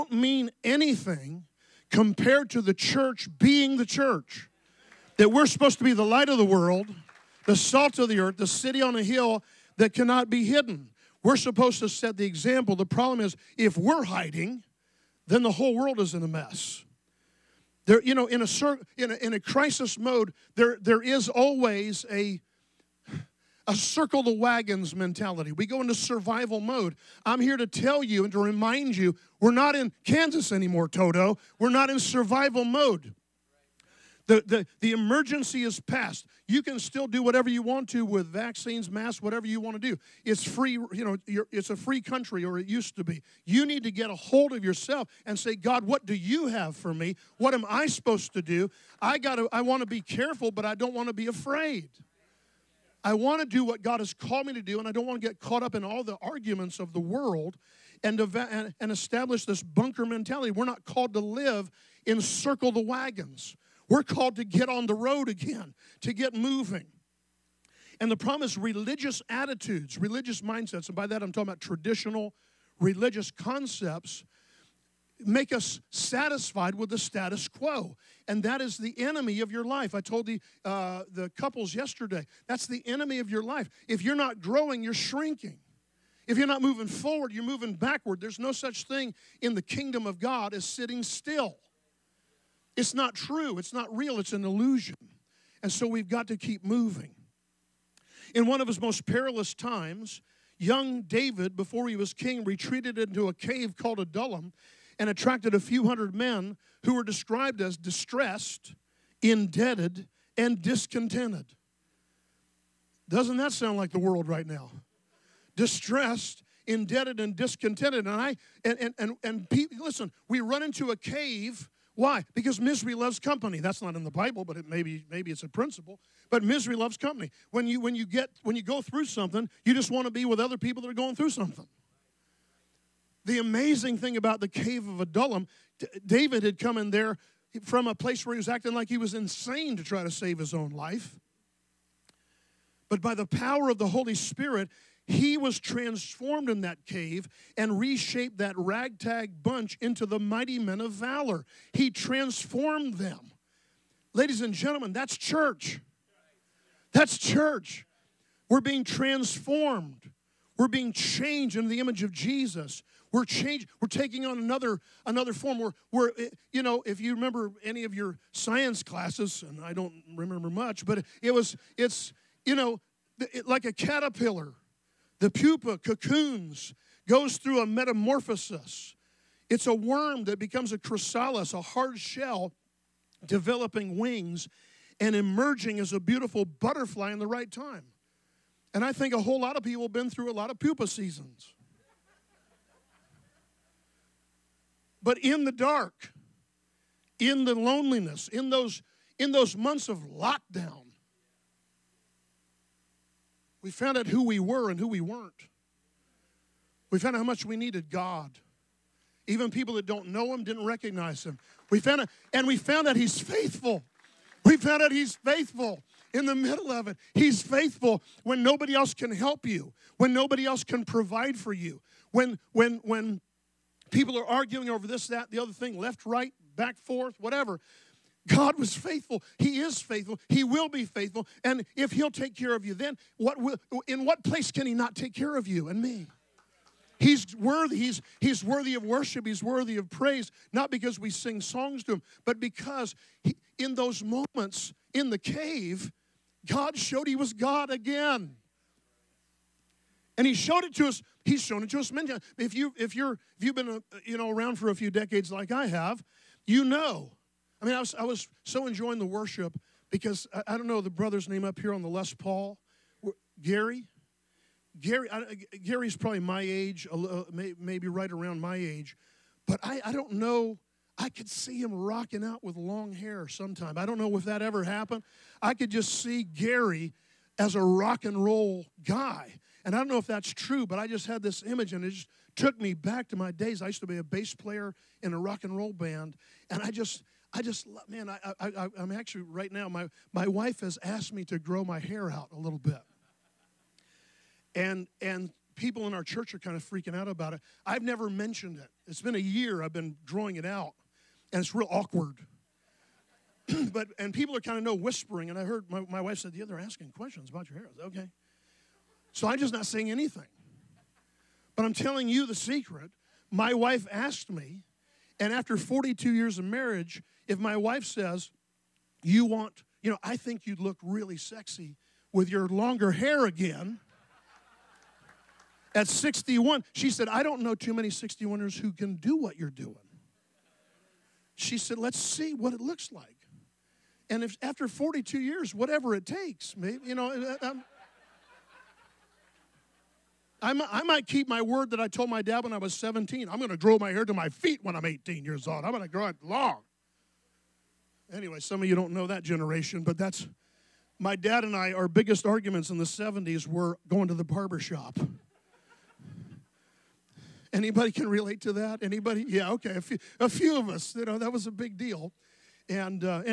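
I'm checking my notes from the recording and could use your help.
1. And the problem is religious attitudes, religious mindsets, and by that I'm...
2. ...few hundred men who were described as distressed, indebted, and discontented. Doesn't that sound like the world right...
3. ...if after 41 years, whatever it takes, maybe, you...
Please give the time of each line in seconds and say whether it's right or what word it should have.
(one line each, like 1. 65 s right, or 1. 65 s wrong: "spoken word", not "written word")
1. 67 s right
2. 105 s right
3. 334 s wrong: "42", not "41".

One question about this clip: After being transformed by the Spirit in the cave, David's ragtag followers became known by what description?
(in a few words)
mighty men of valor.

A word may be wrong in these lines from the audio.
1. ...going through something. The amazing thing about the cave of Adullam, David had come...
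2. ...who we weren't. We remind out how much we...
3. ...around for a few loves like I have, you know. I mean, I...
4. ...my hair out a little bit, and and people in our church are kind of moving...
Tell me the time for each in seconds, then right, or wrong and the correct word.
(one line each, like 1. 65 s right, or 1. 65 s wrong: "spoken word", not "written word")
1. 130 s right
2. 204 s wrong: "found", not "remind"
3. 254 s wrong: "decades", not "loves"
4. 291 s wrong: "freaking", not "moving".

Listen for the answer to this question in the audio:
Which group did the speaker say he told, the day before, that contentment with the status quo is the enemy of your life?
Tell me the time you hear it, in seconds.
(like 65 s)
81 s.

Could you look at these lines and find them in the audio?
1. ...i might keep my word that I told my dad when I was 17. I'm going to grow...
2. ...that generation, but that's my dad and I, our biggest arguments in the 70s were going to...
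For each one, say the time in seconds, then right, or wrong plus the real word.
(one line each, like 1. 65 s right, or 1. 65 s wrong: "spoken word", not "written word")
1. 340 s right
2. 349 s right.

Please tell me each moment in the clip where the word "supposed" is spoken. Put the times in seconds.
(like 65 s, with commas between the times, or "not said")
5 s, 11 s, 47 s.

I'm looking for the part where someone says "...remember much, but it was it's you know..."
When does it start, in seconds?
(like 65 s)
170 s.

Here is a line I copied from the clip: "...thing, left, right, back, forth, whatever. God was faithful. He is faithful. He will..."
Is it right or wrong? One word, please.
right.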